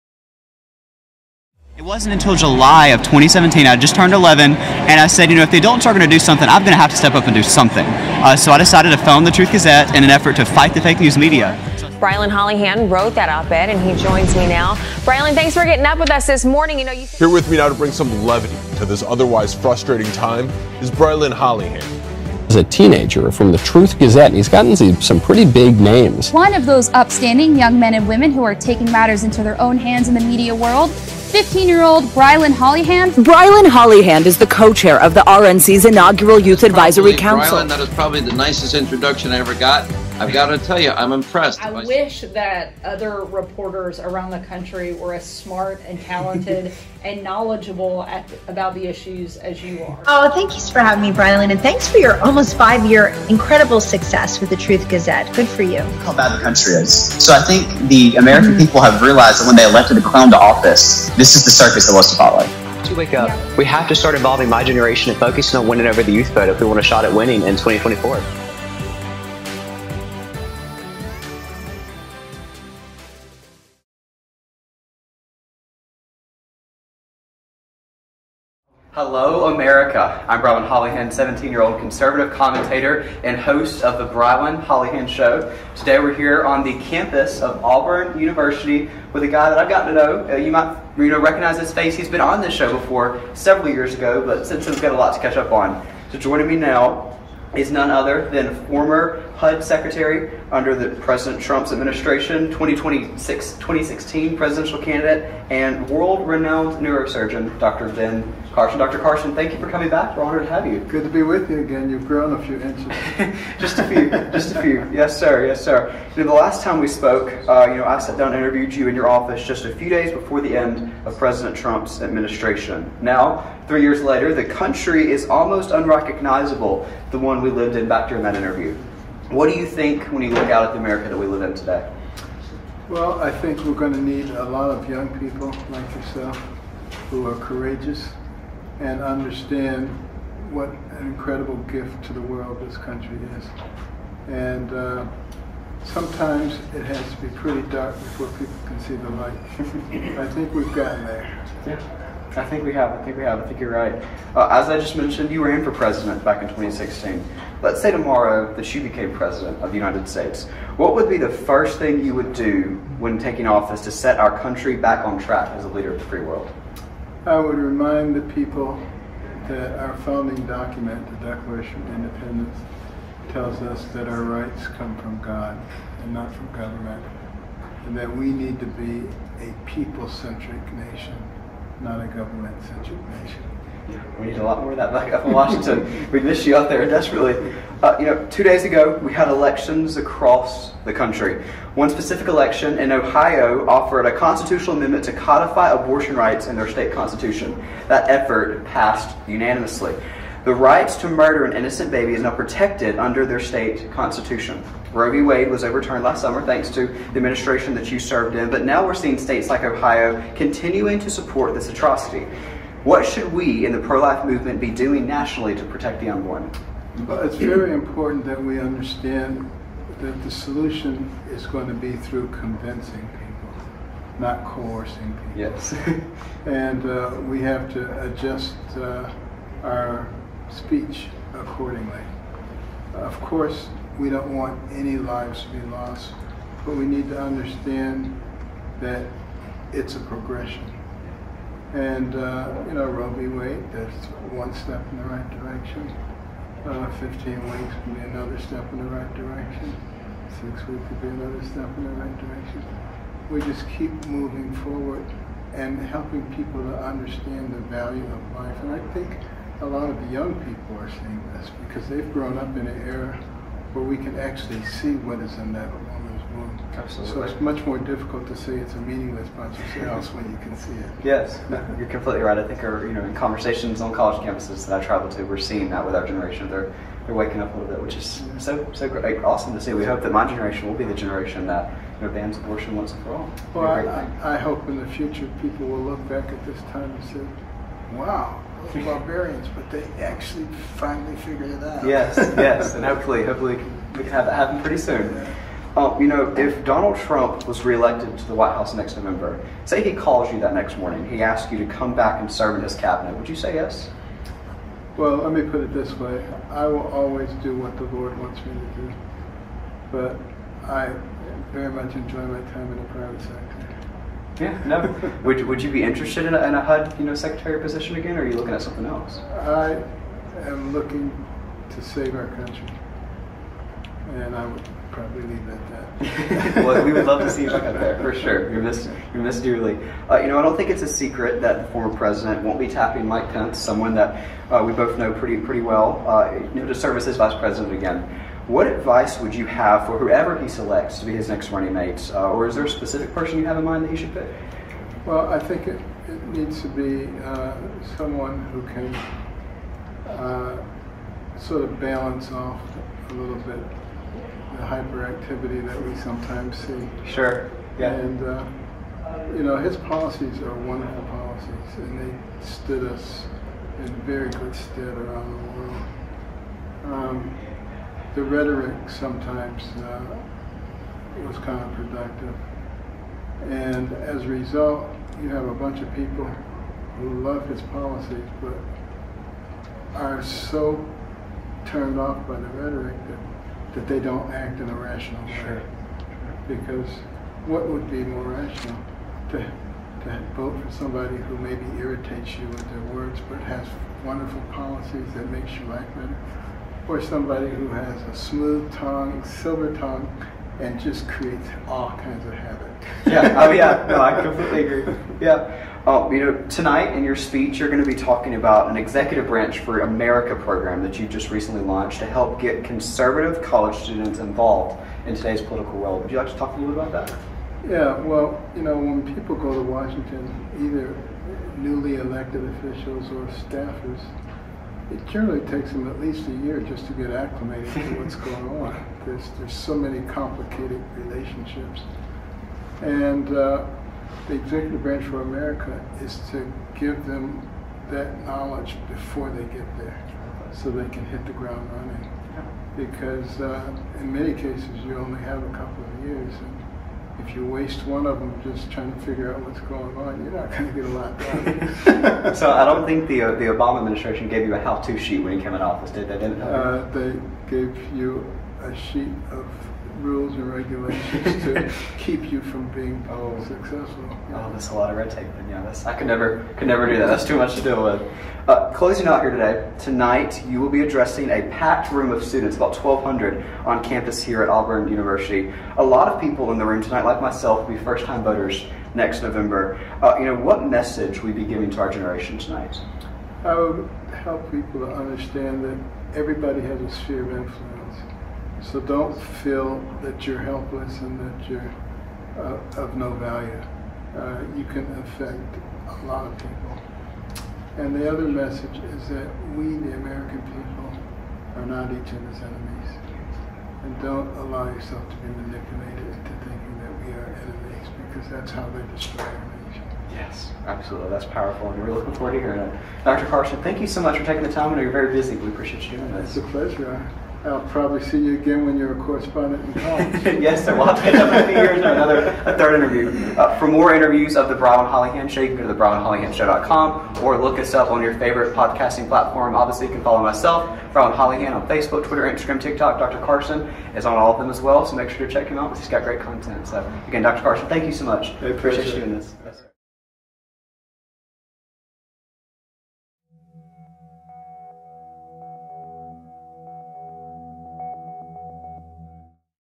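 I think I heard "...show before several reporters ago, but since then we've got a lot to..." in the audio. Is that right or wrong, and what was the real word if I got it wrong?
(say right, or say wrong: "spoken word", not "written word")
wrong: "years", not "reporters".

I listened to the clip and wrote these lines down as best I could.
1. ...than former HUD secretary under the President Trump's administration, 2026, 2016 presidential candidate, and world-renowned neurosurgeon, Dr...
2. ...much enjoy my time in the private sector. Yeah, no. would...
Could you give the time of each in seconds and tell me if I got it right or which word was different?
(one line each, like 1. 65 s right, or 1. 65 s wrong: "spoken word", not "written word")
1. 98 s right
2. 311 s right.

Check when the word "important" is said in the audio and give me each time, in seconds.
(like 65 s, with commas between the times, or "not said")
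217 s.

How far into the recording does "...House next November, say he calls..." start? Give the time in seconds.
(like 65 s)
298 s.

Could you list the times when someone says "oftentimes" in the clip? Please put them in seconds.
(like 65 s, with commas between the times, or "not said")
not said.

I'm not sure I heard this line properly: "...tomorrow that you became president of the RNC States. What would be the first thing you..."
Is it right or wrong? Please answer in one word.
wrong.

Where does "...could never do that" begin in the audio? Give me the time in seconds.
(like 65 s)
466 s.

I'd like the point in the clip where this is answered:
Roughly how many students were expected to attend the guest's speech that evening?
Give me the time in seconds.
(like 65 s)
472 s.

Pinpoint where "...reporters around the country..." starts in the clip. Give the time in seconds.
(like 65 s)
43 s.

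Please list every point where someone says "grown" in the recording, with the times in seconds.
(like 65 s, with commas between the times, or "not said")
112 s, 262 s.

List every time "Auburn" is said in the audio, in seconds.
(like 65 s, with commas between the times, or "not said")
87 s, 474 s.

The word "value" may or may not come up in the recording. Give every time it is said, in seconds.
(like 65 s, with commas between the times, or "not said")
257 s, 493 s.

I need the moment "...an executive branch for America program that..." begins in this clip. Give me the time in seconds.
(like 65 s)
408 s.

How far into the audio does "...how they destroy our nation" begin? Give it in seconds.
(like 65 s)
508 s.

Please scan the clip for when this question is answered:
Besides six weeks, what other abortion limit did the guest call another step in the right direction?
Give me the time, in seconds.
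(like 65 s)
246 s.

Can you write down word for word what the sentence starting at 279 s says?
We hope that my generation will be the generation that you know, bans abortion once and for all.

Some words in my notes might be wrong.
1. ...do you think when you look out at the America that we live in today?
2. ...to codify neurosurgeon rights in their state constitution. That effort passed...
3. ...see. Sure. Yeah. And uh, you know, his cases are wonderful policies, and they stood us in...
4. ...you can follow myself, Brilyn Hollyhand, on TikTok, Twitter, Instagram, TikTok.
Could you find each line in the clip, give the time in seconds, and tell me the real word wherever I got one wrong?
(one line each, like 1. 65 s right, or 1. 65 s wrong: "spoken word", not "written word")
1. 129 s right
2. 195 s wrong: "abortion", not "neurosurgeon"
3. 356 s wrong: "policies", not "cases"
4. 529 s wrong: "Facebook", not "TikTok".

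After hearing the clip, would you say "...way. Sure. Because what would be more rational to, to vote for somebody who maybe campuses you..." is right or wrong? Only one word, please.
wrong.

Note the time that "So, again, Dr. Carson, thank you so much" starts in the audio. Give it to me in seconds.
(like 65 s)
536 s.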